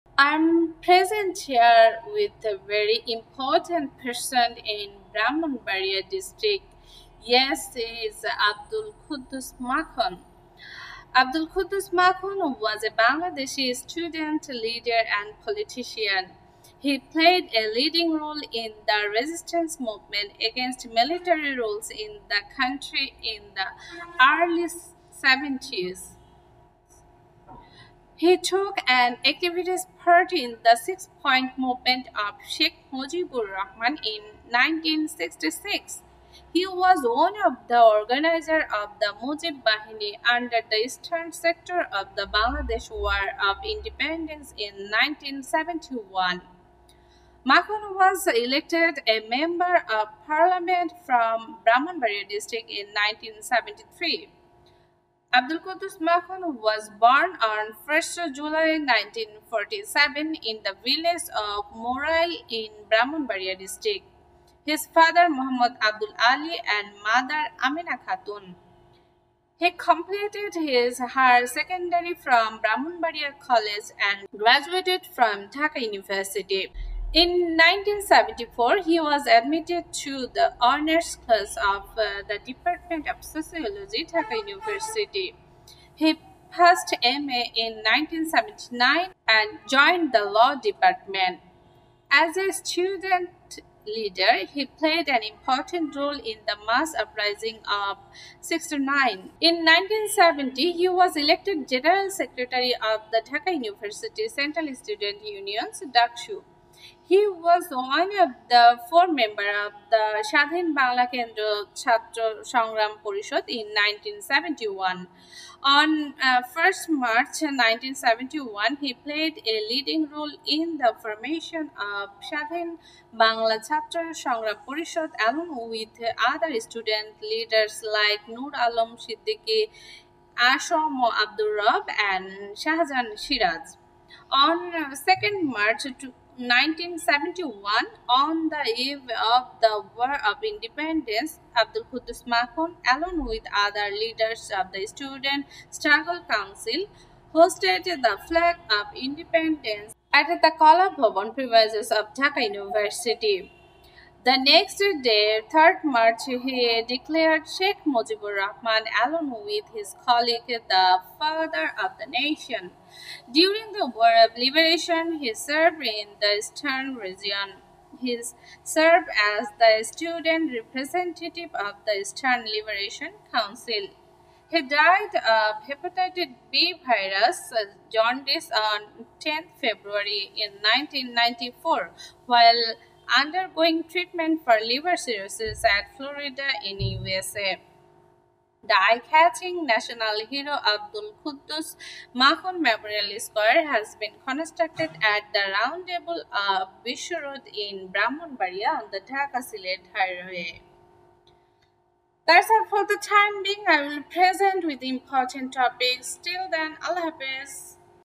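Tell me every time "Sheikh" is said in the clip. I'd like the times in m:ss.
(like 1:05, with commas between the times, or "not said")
0:32, 2:37.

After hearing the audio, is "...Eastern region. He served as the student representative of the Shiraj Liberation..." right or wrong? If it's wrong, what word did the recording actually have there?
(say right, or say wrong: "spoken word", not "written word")
wrong: "Eastern", not "Shiraj".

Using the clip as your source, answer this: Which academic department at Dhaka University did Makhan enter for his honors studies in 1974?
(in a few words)
Sociology.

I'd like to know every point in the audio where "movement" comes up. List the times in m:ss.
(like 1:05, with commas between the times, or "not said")
0:19, 0:31.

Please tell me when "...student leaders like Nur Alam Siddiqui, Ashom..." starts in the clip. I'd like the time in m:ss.
2:06.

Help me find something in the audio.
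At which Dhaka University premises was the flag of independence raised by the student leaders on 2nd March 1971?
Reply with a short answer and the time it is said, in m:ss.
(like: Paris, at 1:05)
Kala Bhavan, at 2:30.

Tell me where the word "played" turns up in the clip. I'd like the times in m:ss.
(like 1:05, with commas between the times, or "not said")
0:16, 1:34, 1:59.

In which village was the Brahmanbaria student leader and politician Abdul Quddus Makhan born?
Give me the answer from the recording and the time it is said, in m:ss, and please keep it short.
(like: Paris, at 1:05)
Morai, at 1:01.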